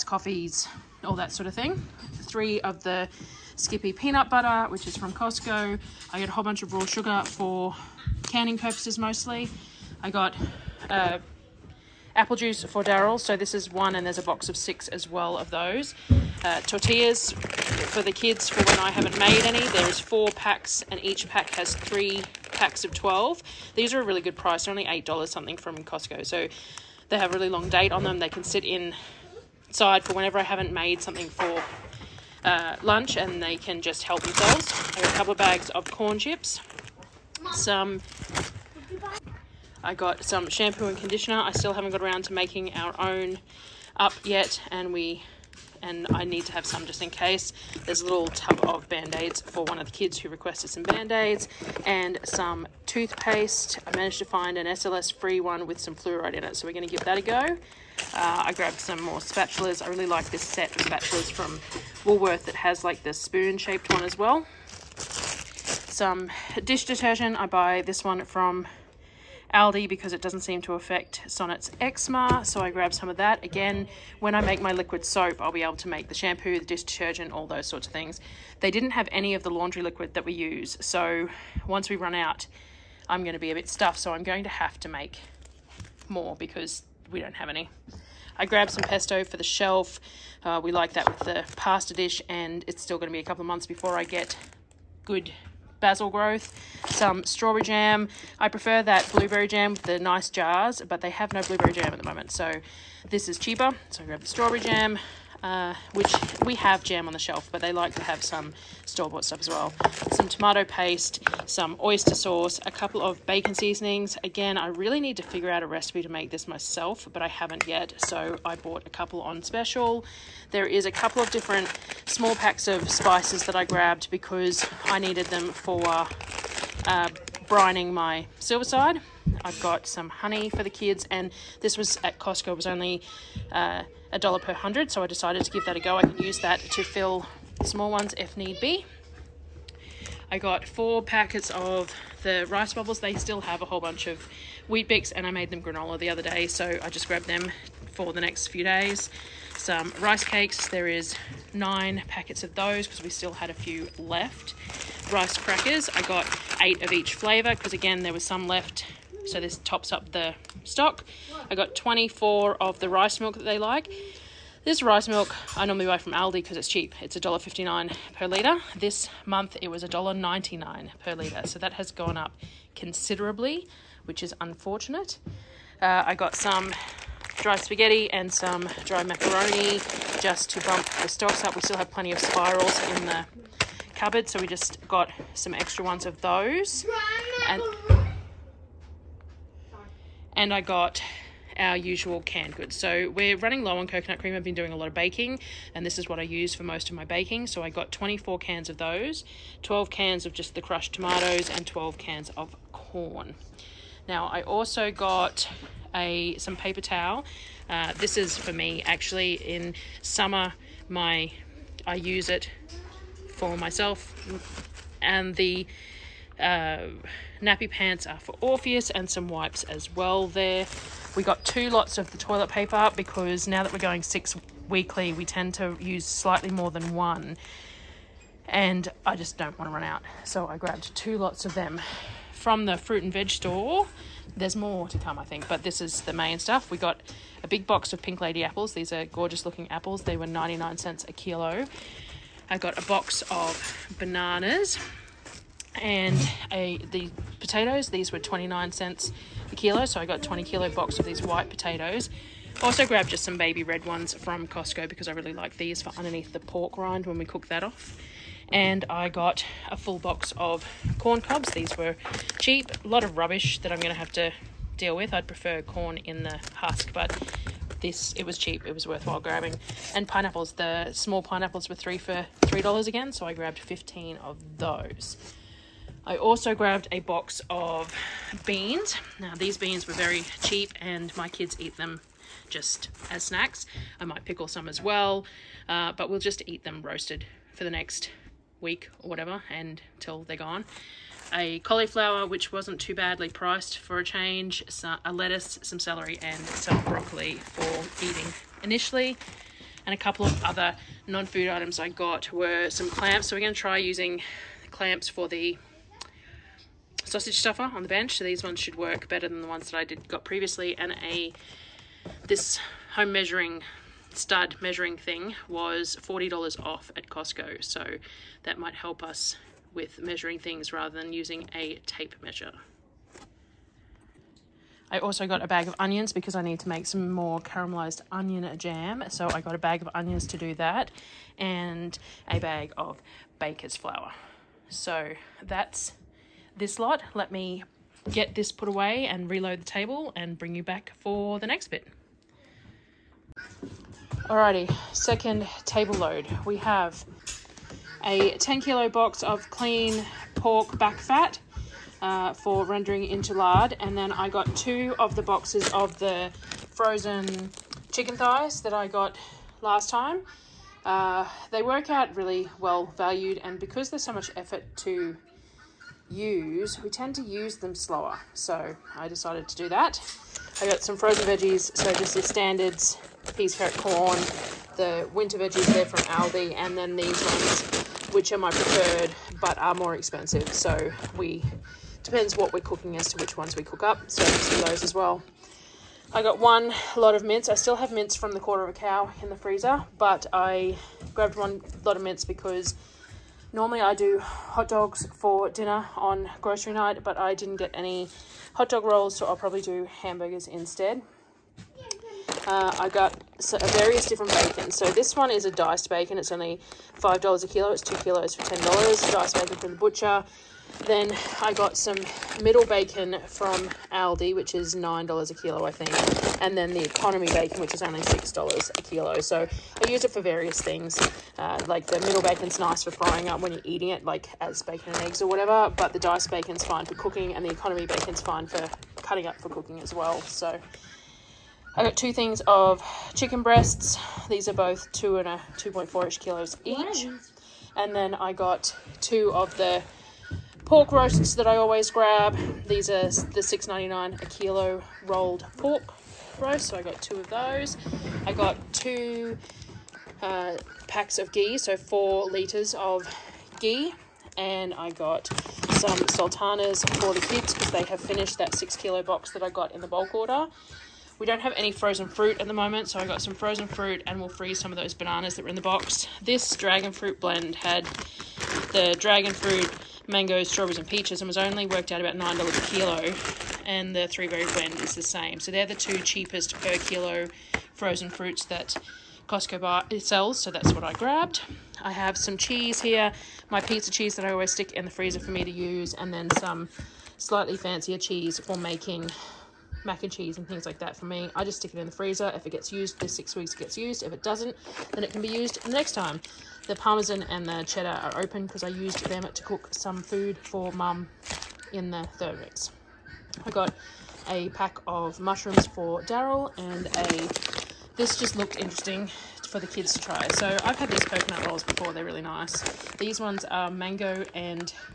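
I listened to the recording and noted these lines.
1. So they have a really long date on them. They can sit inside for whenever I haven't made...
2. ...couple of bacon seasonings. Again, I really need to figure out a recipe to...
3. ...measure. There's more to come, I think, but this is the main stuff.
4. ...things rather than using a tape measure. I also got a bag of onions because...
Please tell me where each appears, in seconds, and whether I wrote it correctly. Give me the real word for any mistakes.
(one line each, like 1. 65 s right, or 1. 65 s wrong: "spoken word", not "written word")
1. 26 s right
2. 112 s right
3. 233 s wrong: "store", not "measure"
4. 320 s right.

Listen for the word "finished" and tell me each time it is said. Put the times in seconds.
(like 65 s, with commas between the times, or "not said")
458 s.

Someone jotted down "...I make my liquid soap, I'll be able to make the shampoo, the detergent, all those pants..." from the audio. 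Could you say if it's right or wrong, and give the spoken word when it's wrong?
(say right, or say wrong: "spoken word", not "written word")
wrong: "sorts", not "pants".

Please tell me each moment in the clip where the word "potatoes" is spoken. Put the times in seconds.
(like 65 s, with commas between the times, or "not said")
247 s, 251 s.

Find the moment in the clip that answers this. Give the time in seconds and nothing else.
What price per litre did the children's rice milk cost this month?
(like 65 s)
169 s.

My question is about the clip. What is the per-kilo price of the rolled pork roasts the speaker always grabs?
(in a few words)
$6.99.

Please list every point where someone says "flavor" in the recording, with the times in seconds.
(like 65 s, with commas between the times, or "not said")
157 s.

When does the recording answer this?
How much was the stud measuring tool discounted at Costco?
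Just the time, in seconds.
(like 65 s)
316 s.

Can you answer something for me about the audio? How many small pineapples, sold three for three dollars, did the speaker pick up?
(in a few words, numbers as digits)
15.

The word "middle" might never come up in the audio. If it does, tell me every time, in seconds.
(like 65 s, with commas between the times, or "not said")
412 s, 422 s.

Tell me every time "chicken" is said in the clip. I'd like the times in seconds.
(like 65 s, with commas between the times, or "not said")
357 s, 433 s.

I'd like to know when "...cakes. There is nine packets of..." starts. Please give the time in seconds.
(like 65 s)
150 s.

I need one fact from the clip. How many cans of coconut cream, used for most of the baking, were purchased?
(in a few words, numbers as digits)
24.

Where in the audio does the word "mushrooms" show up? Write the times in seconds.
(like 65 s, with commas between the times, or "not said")
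505 s.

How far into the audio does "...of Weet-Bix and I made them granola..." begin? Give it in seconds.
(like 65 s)
144 s.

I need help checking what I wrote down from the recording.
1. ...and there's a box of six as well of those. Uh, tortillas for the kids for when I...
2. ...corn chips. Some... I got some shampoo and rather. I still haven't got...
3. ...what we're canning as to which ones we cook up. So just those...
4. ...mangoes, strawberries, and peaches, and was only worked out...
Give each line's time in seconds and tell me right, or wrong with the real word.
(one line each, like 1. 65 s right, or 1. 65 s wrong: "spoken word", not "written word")
1. 13 s right
2. 35 s wrong: "conditioner", not "rather"
3. 382 s wrong: "cooking", not "canning"
4. 470 s right.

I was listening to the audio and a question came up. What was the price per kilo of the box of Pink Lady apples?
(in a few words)
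99 cents.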